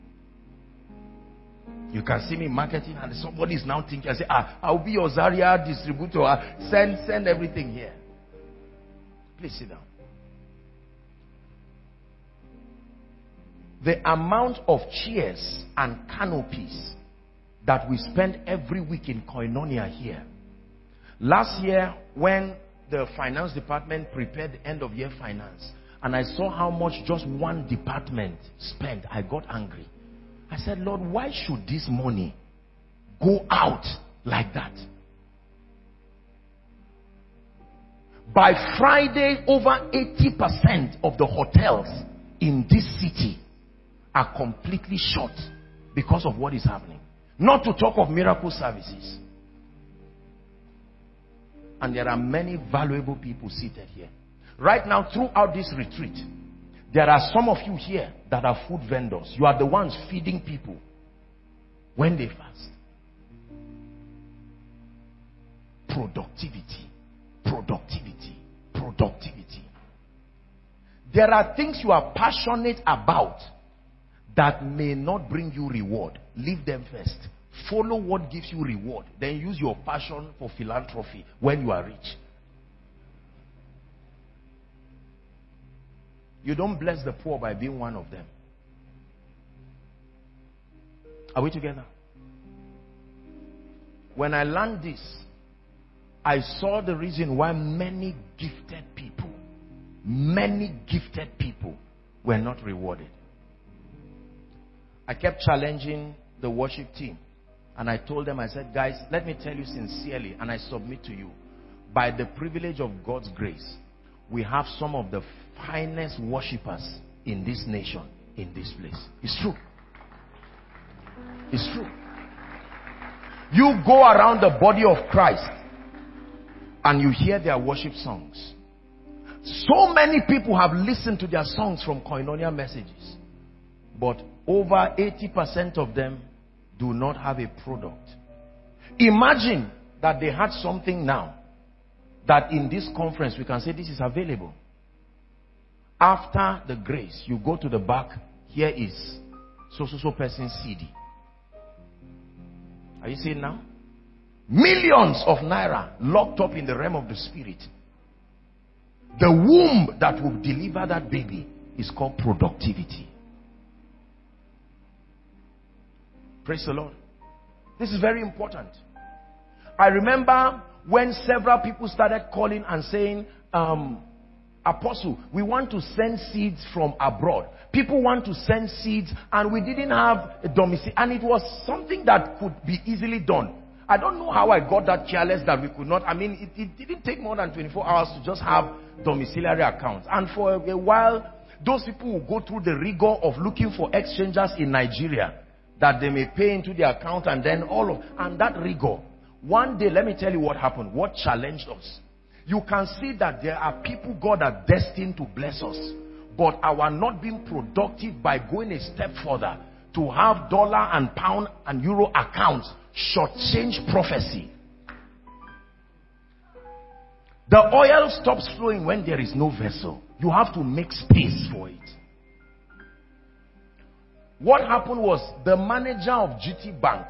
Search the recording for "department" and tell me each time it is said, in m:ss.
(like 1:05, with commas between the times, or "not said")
0:23, 0:27.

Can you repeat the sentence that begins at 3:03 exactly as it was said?
I don't know how I got that careless that we could not.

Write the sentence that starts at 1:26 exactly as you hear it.
You don't bless the poor by being one of them.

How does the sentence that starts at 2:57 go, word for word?
People want to send seeds and we didn't have a domicile.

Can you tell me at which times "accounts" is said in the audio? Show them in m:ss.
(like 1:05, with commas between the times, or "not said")
3:09, 3:16, 3:32.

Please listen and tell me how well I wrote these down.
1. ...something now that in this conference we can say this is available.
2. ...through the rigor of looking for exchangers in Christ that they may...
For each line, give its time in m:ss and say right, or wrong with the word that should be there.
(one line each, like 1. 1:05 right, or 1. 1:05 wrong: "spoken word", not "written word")
1. 2:20 right
2. 3:12 wrong: "Nigeria", not "Christ".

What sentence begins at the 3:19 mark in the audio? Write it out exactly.
One day, let me tell you what happened, what challenged us.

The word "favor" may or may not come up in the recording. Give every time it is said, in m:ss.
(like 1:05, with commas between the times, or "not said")
not said.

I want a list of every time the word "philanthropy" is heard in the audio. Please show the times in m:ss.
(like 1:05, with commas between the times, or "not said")
1:20.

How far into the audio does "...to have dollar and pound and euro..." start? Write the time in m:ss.
3:29.